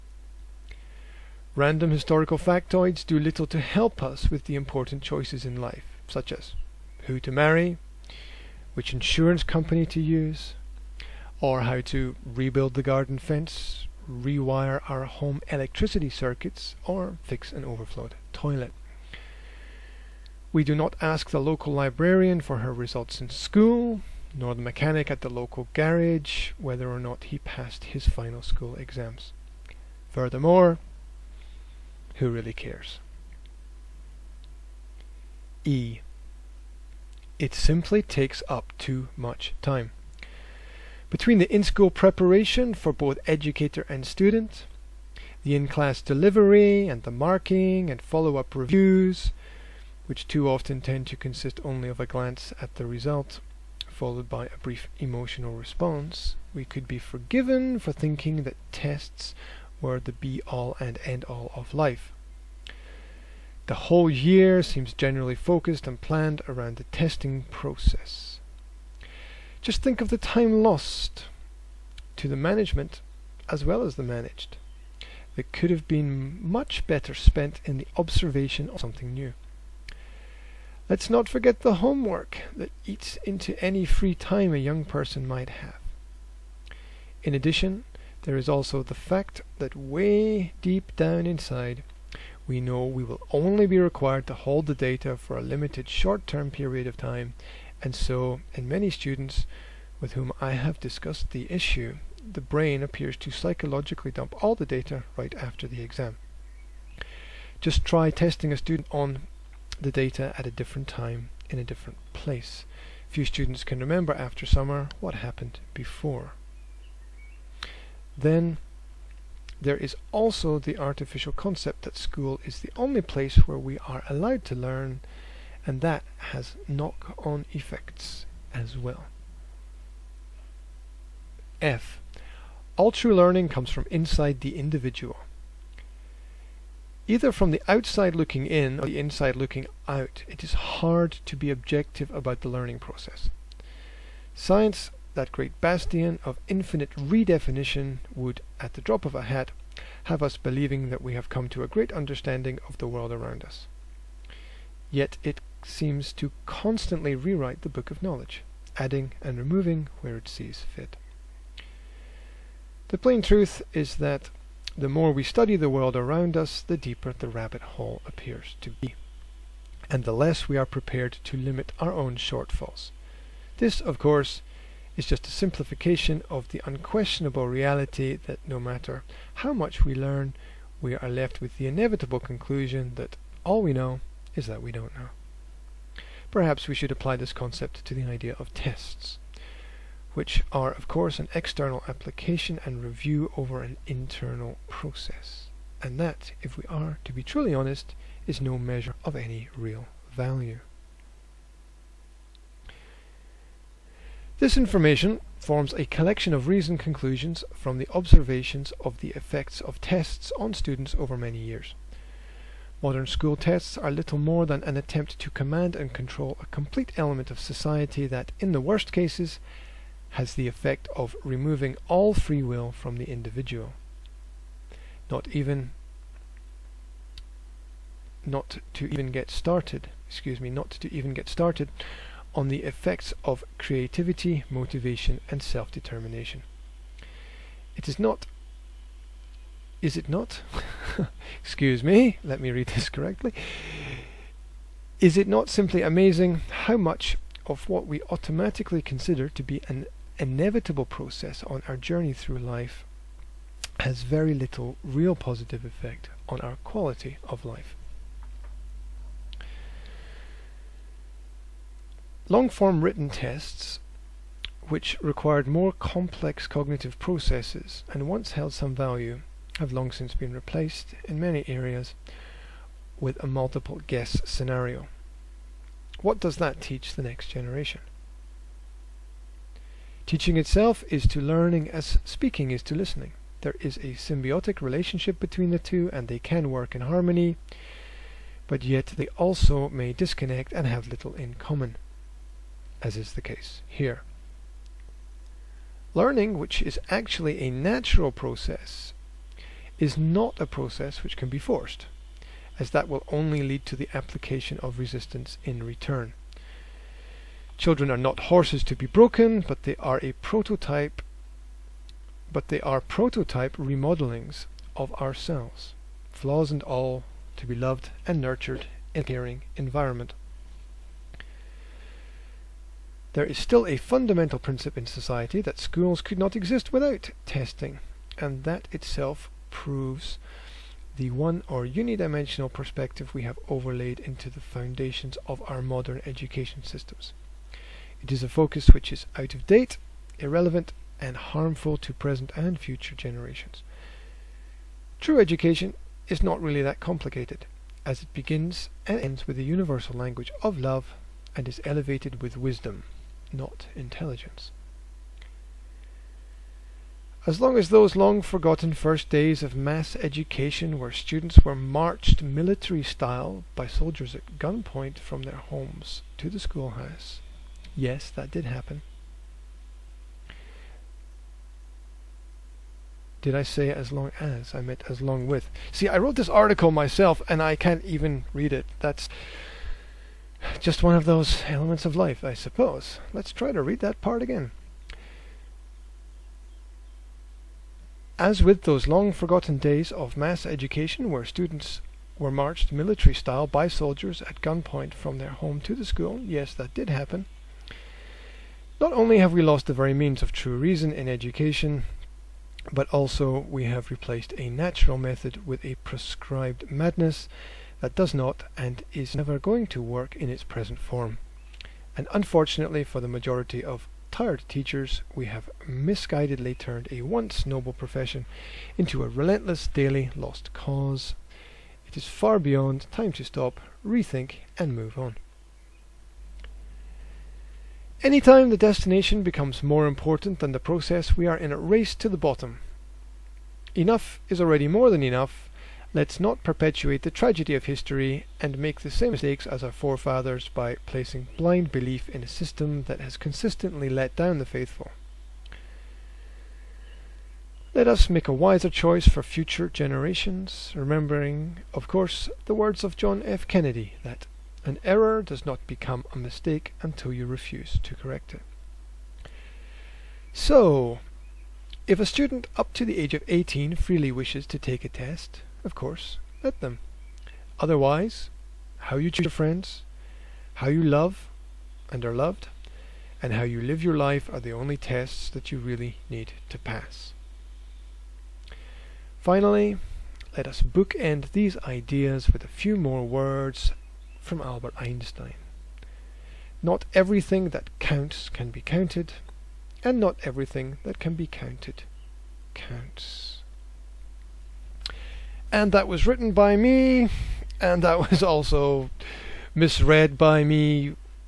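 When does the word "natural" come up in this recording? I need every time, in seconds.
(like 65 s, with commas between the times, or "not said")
297 s, 404 s.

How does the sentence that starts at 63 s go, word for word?
The whole year seems generally focused and planned around the testing process.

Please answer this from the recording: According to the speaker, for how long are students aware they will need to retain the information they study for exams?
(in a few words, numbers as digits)
limited short-term period.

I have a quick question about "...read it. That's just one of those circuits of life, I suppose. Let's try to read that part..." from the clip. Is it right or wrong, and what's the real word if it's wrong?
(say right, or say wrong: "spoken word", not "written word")
wrong: "elements", not "circuits".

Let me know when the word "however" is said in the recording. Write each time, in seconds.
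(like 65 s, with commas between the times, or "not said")
not said.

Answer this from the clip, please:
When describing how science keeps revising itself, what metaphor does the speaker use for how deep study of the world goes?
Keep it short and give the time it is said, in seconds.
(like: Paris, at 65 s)
rabbit hole, at 167 s.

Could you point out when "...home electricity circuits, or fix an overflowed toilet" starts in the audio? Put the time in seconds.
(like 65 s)
15 s.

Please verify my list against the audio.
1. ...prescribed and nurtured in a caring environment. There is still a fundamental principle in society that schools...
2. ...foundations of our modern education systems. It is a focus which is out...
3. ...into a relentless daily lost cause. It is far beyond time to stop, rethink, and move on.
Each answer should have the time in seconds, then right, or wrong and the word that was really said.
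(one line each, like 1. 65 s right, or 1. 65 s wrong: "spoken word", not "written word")
1. 317 s wrong: "loved", not "prescribed"
2. 334 s right
3. 418 s right.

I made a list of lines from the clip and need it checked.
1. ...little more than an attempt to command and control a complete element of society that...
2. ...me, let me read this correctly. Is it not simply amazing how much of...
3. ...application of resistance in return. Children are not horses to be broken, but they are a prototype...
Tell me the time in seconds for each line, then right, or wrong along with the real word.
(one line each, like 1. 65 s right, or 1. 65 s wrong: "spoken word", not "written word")
1. 213 s right
2. 241 s right
3. 303 s right.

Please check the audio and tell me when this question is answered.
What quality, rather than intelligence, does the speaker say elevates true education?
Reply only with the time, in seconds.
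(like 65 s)
352 s.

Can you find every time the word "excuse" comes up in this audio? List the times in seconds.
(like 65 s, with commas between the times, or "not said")
230 s, 241 s.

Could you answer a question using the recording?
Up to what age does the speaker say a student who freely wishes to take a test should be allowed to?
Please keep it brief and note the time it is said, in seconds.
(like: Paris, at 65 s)
18, at 463 s.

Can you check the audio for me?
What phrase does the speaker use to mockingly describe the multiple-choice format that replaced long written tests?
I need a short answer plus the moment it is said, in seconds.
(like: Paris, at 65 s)
multiple guess, at 273 s.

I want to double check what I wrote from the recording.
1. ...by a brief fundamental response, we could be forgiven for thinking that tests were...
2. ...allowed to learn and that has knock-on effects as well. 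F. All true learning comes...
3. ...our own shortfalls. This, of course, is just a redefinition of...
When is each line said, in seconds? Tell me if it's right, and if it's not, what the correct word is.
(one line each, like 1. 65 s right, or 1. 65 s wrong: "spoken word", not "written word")
1. 54 s wrong: "emotional", not "fundamental"
2. 124 s right
3. 171 s wrong: "simplification", not "redefinition".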